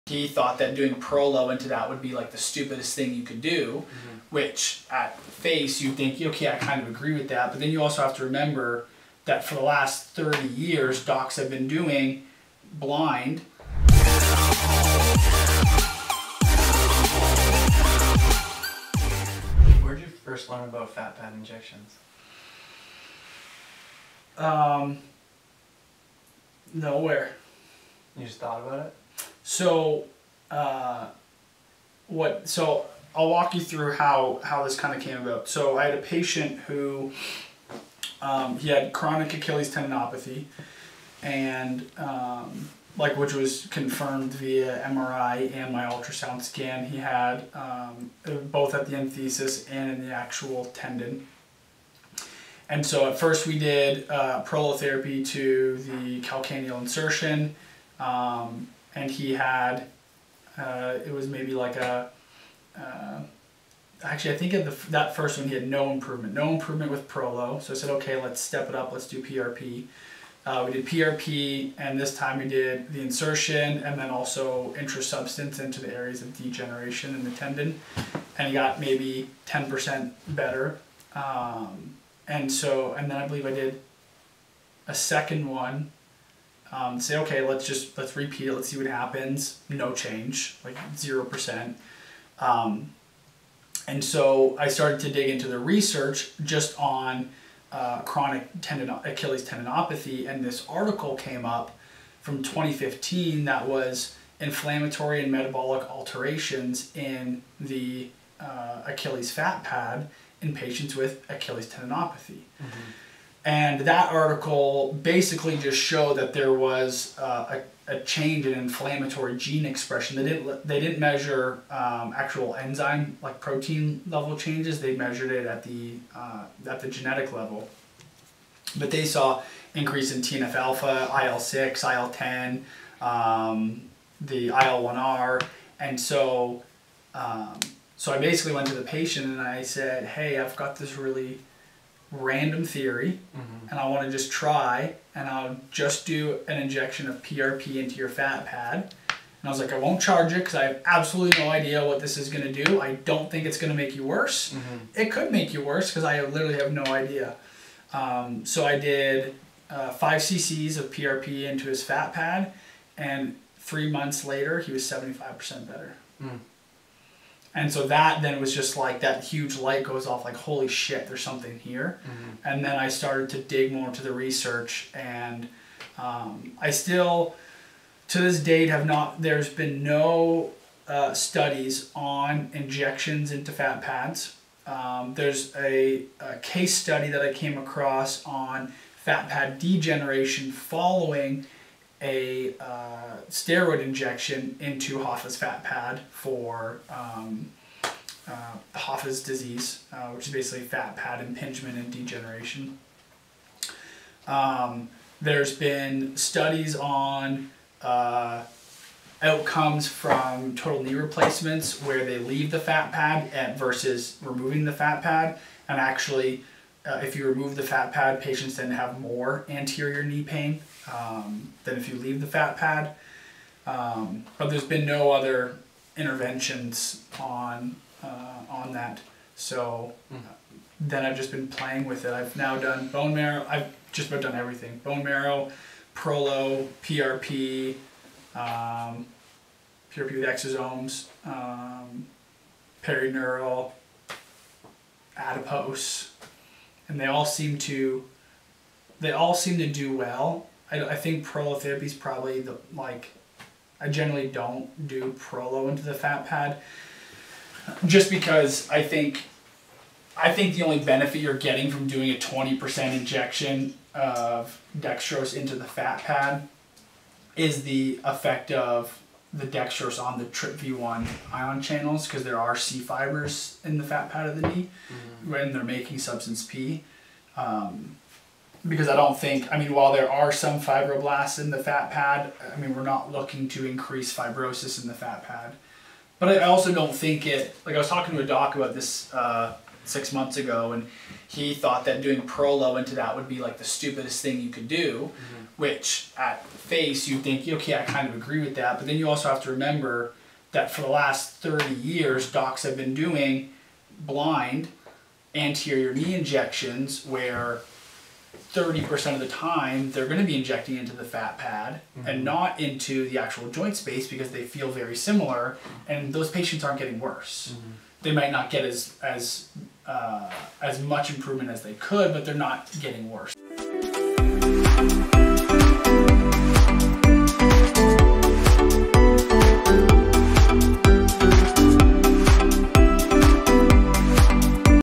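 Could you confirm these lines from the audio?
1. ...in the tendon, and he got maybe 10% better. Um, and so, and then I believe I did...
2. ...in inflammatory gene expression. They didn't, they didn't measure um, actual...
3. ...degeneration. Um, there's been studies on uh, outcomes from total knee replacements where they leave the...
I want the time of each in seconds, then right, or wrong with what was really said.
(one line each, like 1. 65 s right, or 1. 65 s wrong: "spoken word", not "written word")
1. 77 s right
2. 118 s right
3. 201 s right.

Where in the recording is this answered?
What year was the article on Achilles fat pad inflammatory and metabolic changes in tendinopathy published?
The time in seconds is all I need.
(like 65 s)
102 s.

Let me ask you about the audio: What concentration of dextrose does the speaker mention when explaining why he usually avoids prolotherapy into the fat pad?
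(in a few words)
20%.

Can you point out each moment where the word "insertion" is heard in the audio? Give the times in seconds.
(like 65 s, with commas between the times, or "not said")
56 s, 73 s.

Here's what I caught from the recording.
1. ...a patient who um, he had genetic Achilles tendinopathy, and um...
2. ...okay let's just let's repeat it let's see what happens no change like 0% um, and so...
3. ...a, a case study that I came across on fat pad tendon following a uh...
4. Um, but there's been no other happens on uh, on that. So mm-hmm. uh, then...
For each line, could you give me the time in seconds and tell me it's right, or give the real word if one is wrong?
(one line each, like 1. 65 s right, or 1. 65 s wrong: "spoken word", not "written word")
1. 35 s wrong: "chronic", not "genetic"
2. 87 s right
3. 185 s wrong: "degeneration", not "tendon"
4. 223 s wrong: "interventions", not "happens".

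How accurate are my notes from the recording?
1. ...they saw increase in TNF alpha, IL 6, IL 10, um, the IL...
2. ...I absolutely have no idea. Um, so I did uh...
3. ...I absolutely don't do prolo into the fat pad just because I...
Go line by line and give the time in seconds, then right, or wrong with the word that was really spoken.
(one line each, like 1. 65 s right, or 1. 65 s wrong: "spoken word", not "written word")
1. 128 s right
2. 156 s wrong: "literally", not "absolutely"
3. 253 s wrong: "generally", not "absolutely".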